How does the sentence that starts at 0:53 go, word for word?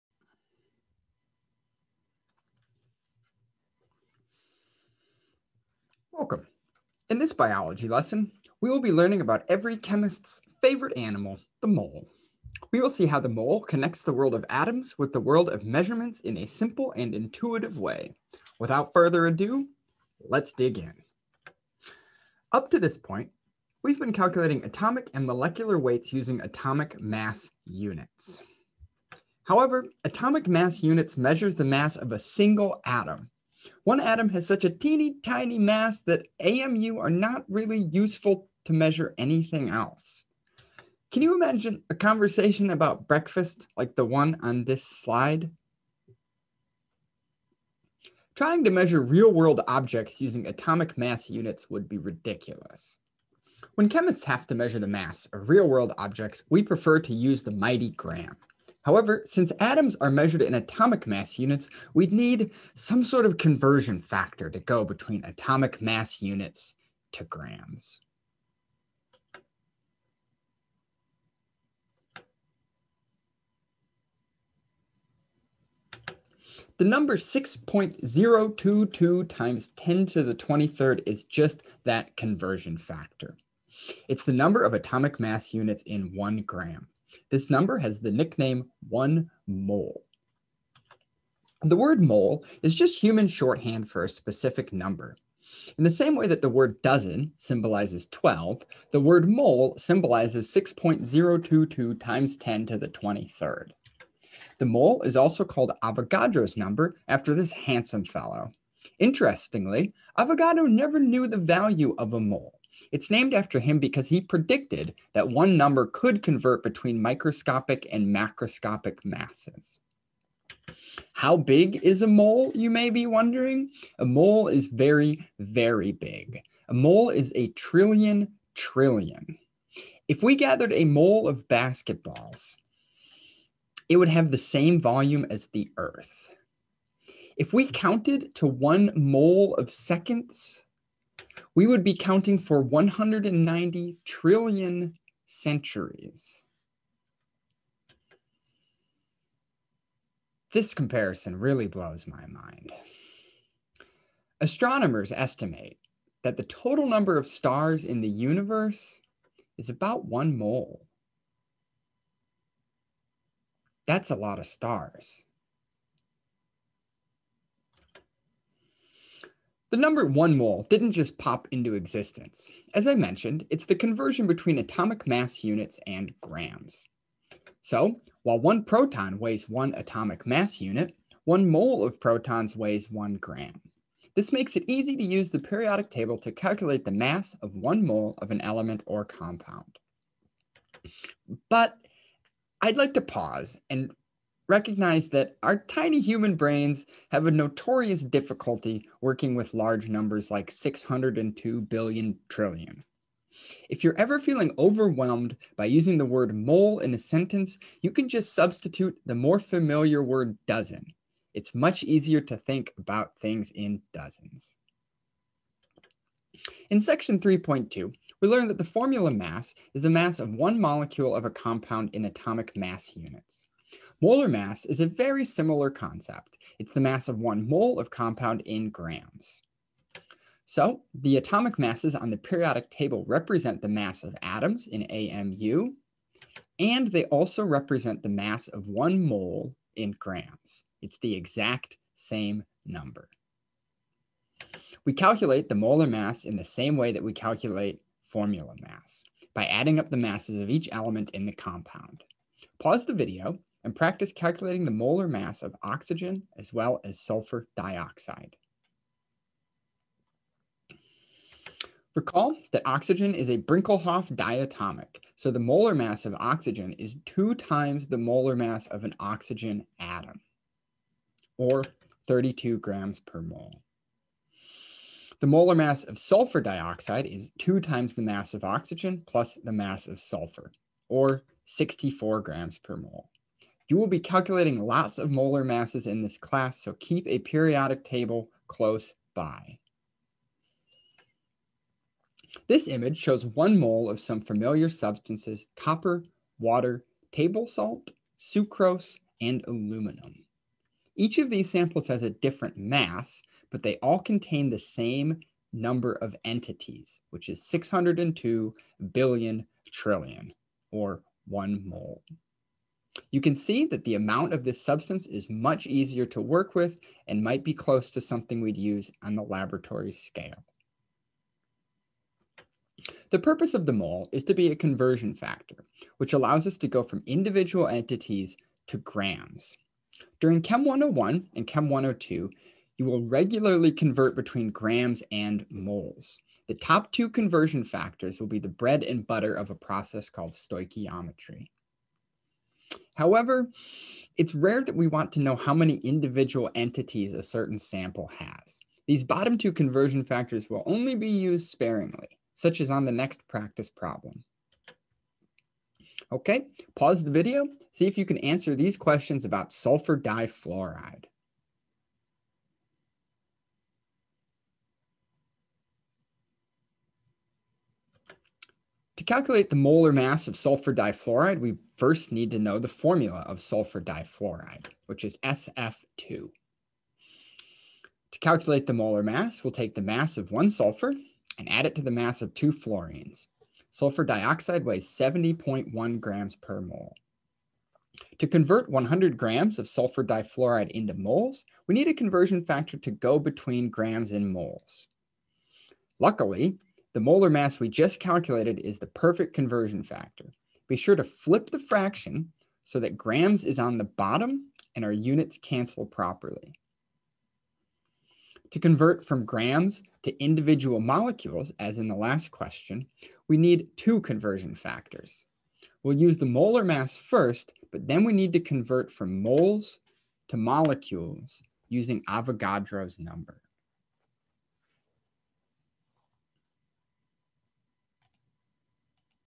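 When chemists have to measure the mass of real world objects, we prefer to use the mighty gram.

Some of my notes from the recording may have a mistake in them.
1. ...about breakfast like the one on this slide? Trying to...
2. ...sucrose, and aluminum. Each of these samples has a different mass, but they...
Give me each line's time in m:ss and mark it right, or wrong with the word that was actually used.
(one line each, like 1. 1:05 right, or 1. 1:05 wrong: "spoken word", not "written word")
1. 0:42 right
2. 4:58 right.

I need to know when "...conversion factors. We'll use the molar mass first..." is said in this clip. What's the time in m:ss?
6:54.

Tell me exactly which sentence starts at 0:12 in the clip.
We will see how the mole connects the world of atoms with the world of measurements in a simple and intuitive way.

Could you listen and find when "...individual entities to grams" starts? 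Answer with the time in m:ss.
5:27.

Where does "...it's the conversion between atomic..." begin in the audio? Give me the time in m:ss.
2:53.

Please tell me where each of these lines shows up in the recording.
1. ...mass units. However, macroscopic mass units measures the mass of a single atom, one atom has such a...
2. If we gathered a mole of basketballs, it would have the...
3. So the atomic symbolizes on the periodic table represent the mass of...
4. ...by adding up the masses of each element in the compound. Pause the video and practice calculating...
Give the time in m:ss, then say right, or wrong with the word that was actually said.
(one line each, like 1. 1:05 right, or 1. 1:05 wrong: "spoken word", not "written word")
1. 0:26 wrong: "atomic", not "macroscopic"
2. 2:10 right
3. 3:50 wrong: "masses", not "symbolizes"
4. 4:09 right.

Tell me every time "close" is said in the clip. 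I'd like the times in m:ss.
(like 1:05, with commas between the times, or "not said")
4:48, 5:17.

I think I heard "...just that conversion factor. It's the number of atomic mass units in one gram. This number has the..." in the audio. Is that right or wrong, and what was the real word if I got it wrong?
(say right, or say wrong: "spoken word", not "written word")
right.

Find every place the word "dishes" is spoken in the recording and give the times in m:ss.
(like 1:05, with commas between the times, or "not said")
not said.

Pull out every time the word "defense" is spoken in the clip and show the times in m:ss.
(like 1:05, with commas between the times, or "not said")
not said.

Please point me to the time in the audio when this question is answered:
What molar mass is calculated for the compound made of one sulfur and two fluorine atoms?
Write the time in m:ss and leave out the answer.
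6:24.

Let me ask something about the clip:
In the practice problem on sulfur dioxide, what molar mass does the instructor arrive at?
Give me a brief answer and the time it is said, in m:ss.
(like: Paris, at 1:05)
64 grams per mole, at 4:41.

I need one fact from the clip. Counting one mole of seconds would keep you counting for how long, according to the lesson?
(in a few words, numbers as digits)
190 trillion centuries.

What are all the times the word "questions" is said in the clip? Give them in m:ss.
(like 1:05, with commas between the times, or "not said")
5:58, 6:52.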